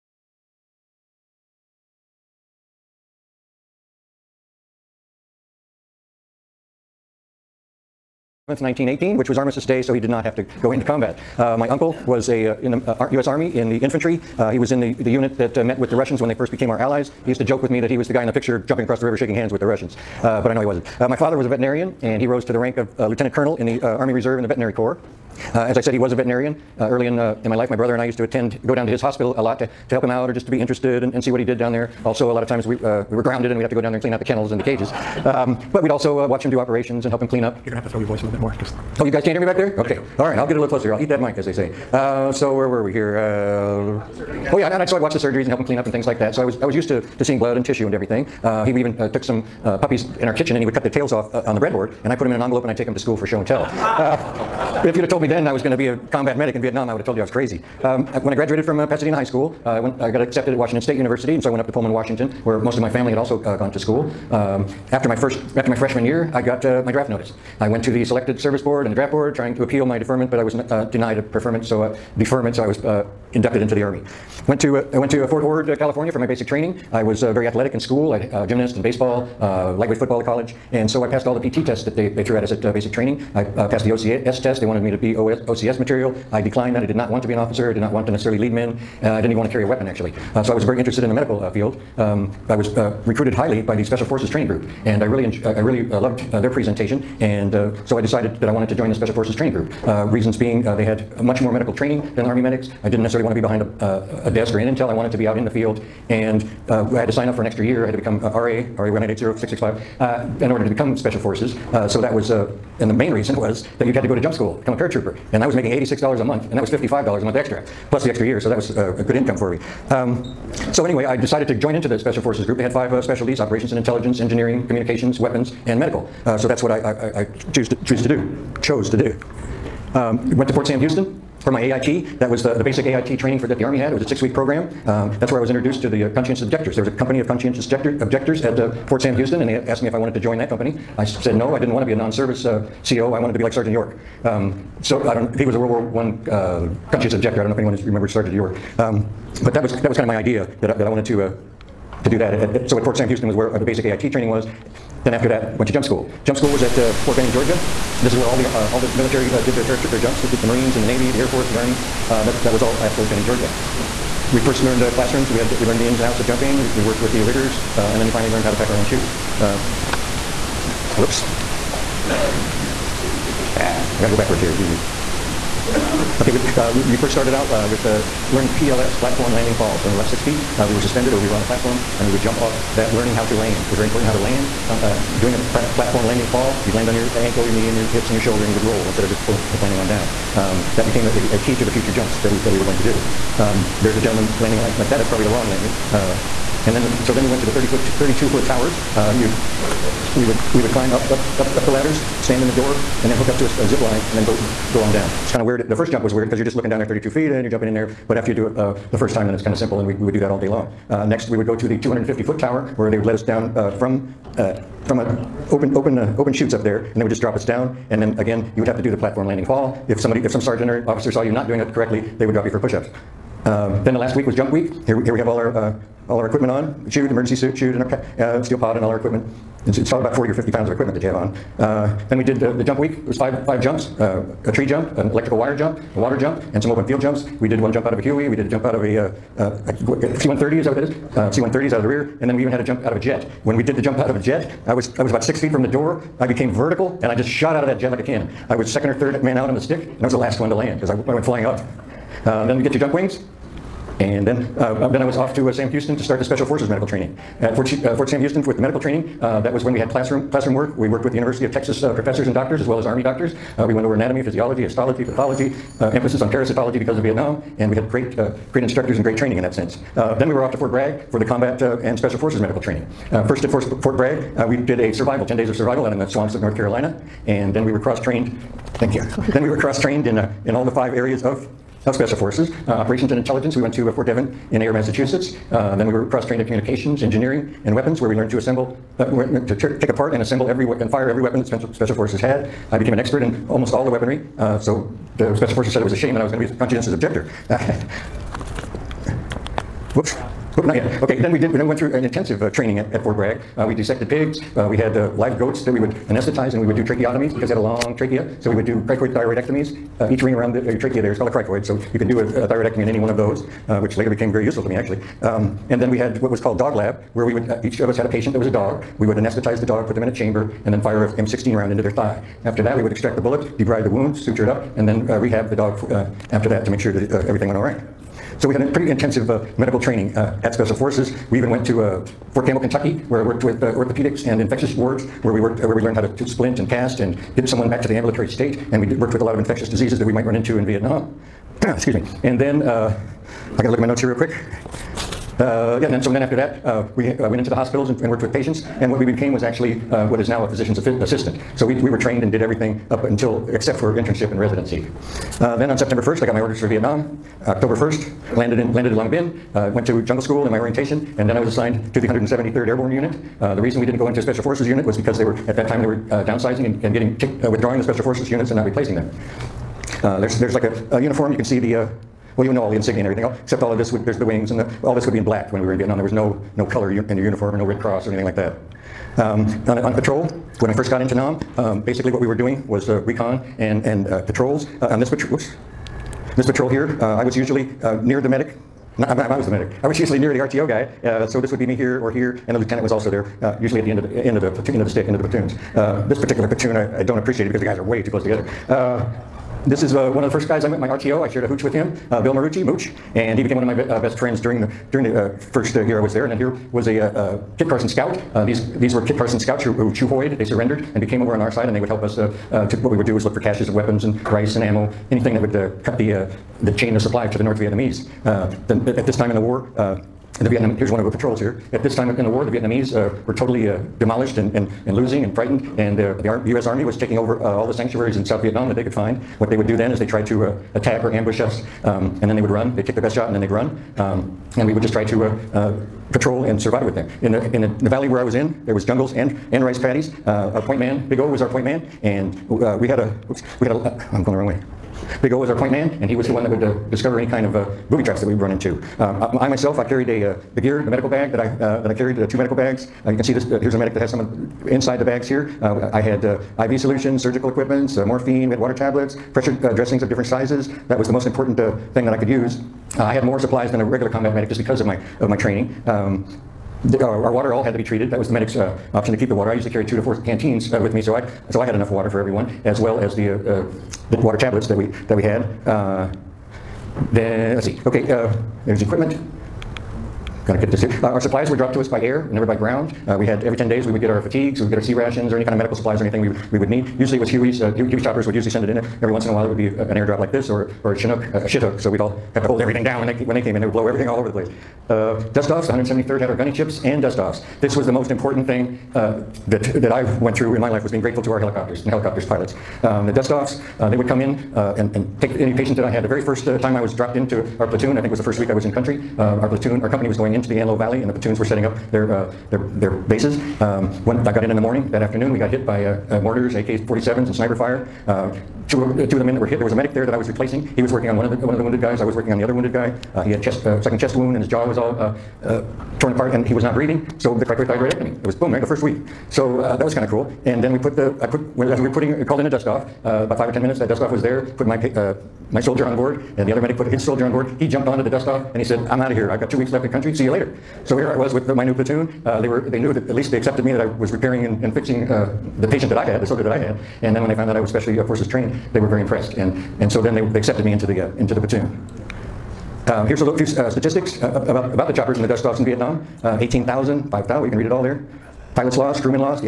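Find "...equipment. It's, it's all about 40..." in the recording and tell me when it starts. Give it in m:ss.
3:48.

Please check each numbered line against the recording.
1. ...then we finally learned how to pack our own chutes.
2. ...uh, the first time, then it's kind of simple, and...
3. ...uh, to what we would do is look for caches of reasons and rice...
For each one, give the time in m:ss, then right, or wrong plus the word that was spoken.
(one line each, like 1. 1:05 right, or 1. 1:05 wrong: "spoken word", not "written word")
1. 2:47 right
2. 3:28 right
3. 6:52 wrong: "weapons", not "reasons".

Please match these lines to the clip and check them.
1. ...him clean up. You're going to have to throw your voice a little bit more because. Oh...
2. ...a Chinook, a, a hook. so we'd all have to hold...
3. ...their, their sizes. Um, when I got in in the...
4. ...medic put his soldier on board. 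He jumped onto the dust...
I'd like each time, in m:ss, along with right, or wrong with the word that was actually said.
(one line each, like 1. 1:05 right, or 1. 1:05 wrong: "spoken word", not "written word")
1. 0:37 right
2. 8:10 right
3. 8:32 wrong: "bases", not "sizes"
4. 8:56 right.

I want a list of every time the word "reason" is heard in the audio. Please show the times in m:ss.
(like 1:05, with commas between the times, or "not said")
1:40, 1:53, 6:03.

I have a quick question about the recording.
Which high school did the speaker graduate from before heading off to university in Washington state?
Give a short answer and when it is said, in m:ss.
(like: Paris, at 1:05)
Pasadena High School, at 0:58.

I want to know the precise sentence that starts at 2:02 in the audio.
They had five uh, specialties, operations and intelligence, engineering, communications, weapons, and medical.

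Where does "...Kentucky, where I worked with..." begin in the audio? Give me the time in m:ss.
5:32.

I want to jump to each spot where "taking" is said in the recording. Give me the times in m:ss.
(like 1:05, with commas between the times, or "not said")
7:06.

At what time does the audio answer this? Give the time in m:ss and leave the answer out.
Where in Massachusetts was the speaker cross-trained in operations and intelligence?
4:43.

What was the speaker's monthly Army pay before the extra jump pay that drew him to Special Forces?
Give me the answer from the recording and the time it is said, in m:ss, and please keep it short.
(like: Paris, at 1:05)
$86, at 1:55.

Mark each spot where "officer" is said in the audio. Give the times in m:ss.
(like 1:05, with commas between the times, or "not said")
1:27, 3:40.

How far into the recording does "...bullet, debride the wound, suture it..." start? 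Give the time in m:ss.
5:23.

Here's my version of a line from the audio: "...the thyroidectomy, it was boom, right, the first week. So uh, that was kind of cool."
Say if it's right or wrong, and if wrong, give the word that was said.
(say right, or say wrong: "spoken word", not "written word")
wrong: "cricothyroidectomy", not "thyroidectomy".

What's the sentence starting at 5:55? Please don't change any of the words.
Uh, then on September 1st, I got my orders for Vietnam.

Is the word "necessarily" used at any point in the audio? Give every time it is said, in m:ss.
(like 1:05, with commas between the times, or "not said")
1:28, 1:43.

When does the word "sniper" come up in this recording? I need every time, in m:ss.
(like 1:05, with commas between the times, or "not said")
8:37.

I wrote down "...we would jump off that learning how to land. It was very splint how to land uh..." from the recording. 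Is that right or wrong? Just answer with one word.
wrong.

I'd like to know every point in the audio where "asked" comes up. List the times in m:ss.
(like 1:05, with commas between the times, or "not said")
2:19.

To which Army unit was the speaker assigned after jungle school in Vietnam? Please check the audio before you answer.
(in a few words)
173rd Airborne.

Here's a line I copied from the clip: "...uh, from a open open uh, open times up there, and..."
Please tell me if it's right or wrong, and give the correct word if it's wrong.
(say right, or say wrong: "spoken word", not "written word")
wrong: "chutes", not "times".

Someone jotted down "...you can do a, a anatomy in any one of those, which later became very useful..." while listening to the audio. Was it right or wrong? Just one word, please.
wrong.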